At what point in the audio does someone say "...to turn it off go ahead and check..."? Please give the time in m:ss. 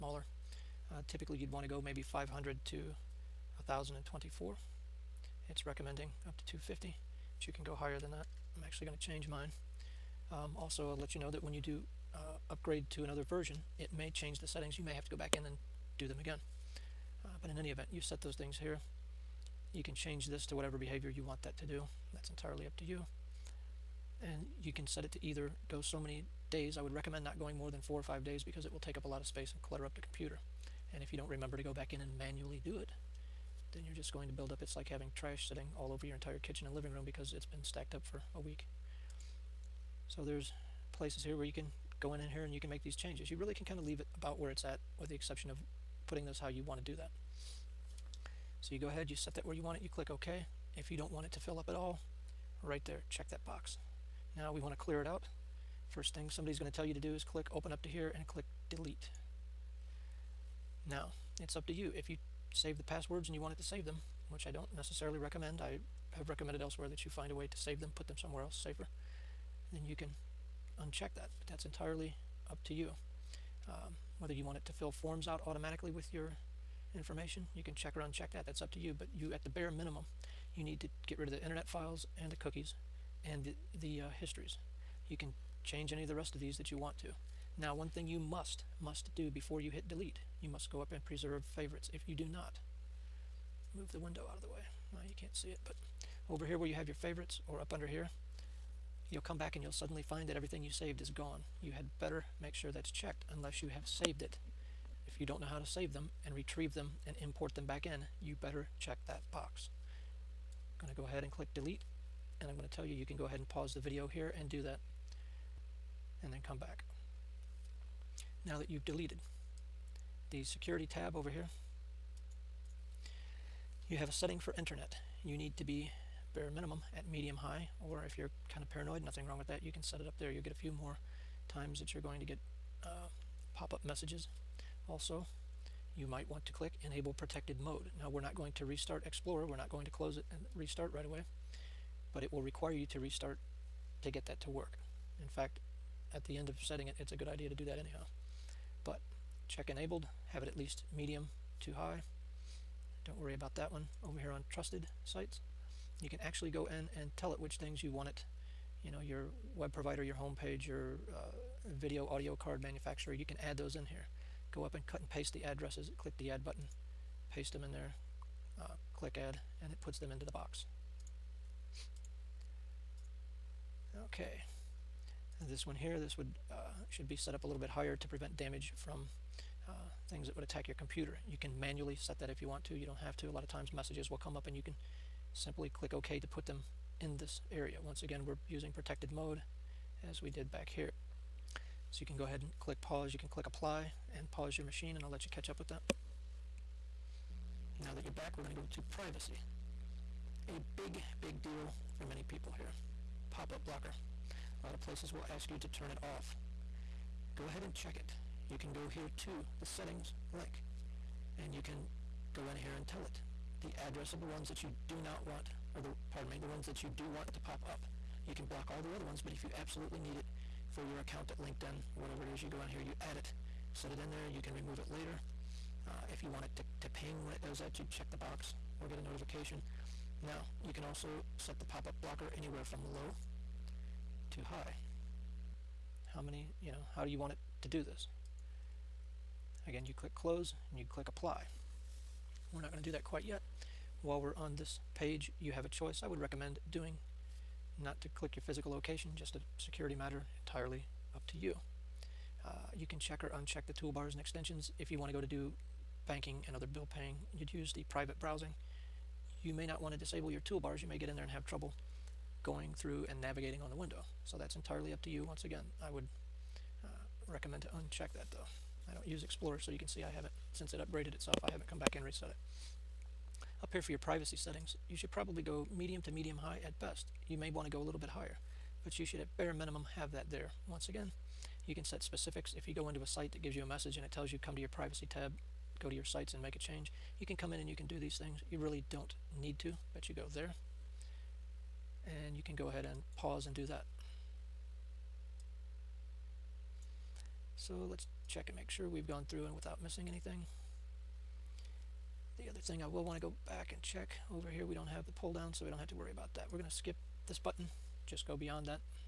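3:25.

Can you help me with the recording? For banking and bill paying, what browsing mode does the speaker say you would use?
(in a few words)
Private browsing.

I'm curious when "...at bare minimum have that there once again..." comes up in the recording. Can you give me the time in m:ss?
4:39.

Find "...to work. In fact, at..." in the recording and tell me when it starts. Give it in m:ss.
2:24.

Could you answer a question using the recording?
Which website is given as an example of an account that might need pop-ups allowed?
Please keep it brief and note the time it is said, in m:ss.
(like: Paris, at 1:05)
LinkedIn, at 3:41.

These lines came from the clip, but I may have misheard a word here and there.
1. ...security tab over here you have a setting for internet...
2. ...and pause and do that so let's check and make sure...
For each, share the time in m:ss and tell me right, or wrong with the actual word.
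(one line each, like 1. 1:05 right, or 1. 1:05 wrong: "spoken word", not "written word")
1. 2:00 right
2. 4:52 right.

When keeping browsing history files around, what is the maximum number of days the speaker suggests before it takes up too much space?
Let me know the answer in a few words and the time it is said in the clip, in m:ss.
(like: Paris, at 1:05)
4 or 5 days, at 0:27.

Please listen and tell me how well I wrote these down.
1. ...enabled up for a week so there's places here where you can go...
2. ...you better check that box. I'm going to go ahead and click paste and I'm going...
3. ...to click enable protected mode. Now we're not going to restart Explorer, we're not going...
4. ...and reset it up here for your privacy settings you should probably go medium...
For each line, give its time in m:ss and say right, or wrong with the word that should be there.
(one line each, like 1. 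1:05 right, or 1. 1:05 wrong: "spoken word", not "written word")
1. 0:37 wrong: "stacked", not "enabled"
2. 1:48 wrong: "delete", not "paste"
3. 2:16 right
4. 4:31 right.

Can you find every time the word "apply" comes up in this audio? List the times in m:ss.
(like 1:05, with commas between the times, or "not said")
3:13, 4:01.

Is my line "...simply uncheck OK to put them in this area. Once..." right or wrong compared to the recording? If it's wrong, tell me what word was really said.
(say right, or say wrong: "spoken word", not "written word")
wrong: "click", not "uncheck".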